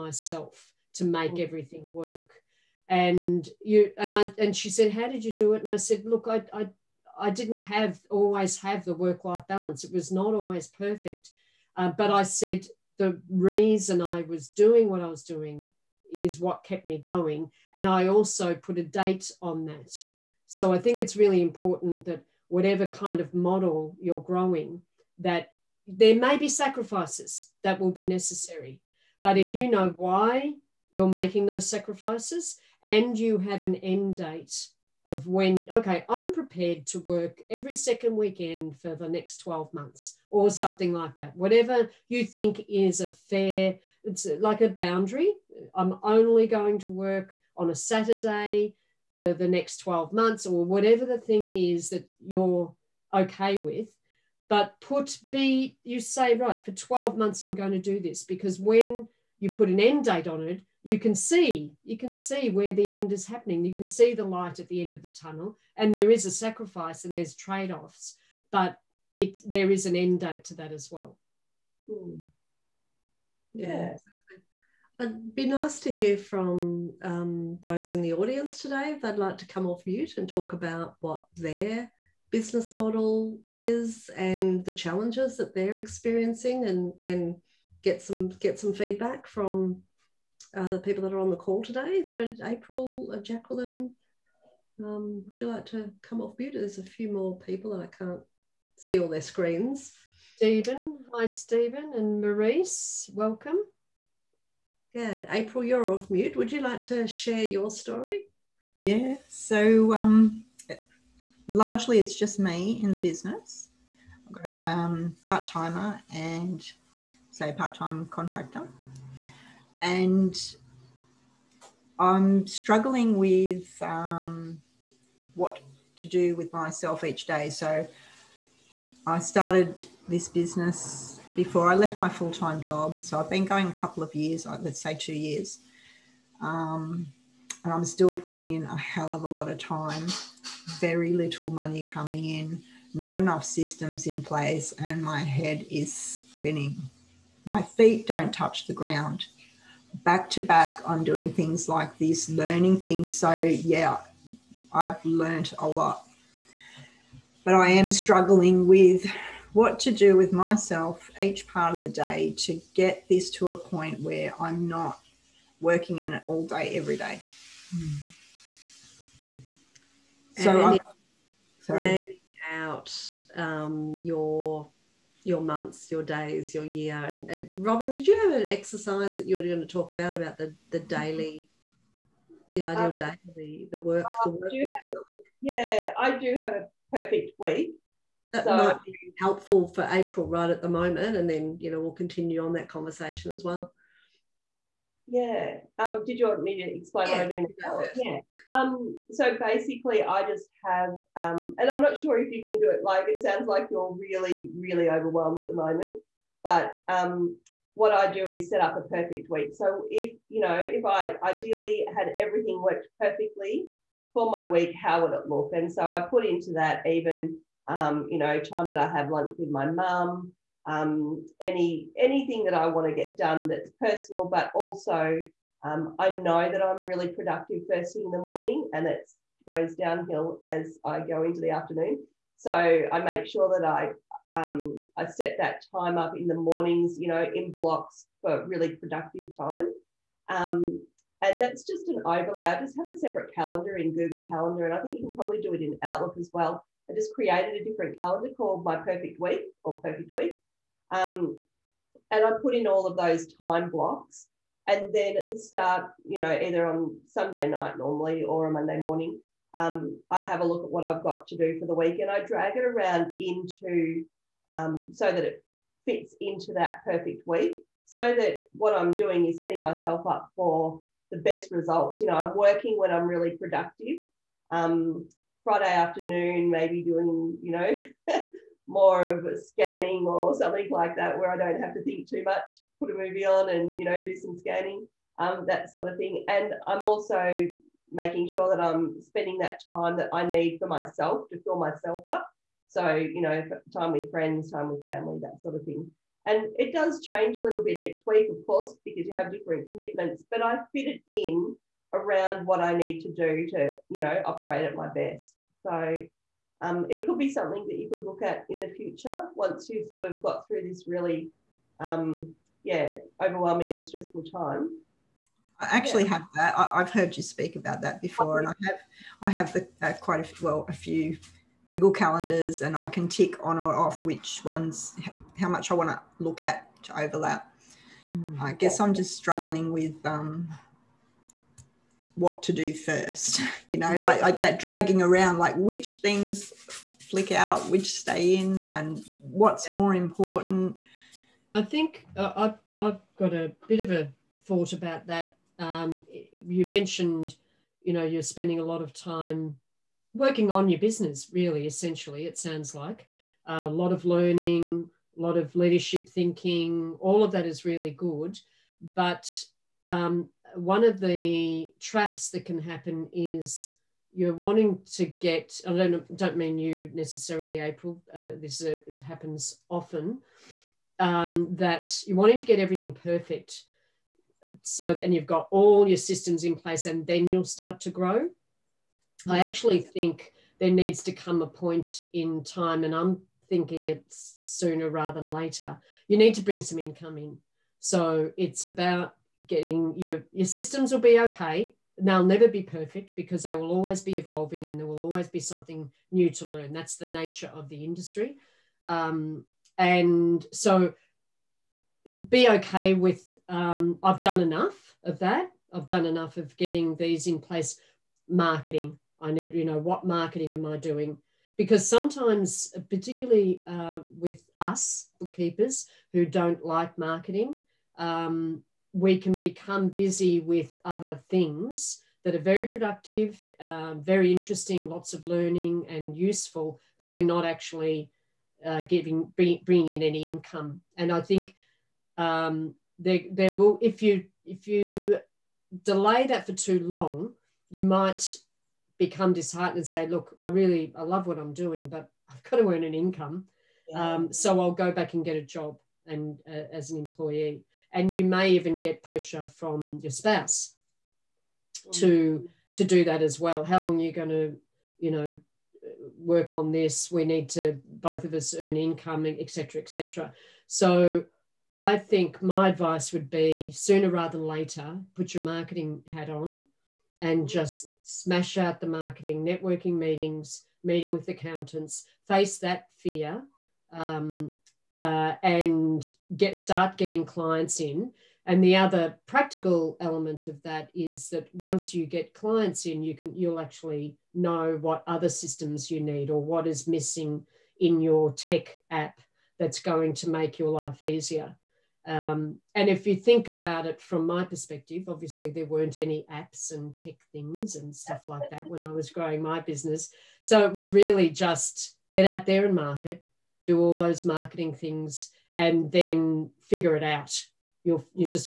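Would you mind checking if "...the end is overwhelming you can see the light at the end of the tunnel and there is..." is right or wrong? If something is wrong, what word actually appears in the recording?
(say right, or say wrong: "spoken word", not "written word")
wrong: "happening", not "overwhelming".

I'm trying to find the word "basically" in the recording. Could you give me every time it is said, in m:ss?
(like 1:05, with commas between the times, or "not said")
3:19.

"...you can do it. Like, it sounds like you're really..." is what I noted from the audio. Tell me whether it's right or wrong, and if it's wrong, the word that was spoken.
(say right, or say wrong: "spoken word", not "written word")
right.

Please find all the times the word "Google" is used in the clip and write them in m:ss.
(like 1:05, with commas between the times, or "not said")
4:03, 5:21.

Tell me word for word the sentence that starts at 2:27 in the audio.
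My feet don't touch the ground.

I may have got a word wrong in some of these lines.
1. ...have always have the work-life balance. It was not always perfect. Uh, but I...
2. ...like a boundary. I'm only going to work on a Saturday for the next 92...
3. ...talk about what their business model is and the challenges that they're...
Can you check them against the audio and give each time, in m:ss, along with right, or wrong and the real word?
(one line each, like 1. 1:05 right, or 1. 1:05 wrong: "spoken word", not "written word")
1. 0:07 right
2. 0:44 wrong: "12", not "92"
3. 1:20 right.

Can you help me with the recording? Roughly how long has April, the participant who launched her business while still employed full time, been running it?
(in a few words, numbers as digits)
two years.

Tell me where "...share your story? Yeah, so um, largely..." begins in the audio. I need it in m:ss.
1:47.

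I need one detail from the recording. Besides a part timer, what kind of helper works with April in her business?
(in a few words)
part time contractor.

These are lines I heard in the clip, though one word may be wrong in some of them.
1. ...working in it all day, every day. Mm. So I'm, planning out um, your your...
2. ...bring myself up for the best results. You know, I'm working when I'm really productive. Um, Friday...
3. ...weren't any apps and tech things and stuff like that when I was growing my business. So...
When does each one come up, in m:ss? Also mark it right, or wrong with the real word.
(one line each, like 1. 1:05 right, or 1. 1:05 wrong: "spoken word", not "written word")
1. 2:45 right
2. 4:29 wrong: "setting", not "bring"
3. 8:15 right.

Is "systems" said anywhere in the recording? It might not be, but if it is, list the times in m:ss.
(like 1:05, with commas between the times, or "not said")
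2:23, 6:15, 6:30, 8:05.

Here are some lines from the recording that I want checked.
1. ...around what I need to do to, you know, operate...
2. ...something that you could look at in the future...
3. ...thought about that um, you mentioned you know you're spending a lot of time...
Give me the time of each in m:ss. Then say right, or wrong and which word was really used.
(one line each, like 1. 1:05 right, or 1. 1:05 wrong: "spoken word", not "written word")
1. 5:01 right
2. 5:07 right
3. 5:44 right.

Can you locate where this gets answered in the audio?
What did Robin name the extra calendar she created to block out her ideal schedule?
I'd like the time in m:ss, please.
4:08.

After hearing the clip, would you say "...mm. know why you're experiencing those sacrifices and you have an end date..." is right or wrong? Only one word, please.
wrong.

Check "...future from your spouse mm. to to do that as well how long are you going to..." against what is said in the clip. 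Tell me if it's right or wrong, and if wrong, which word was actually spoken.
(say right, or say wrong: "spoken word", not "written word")
wrong: "pressure", not "future".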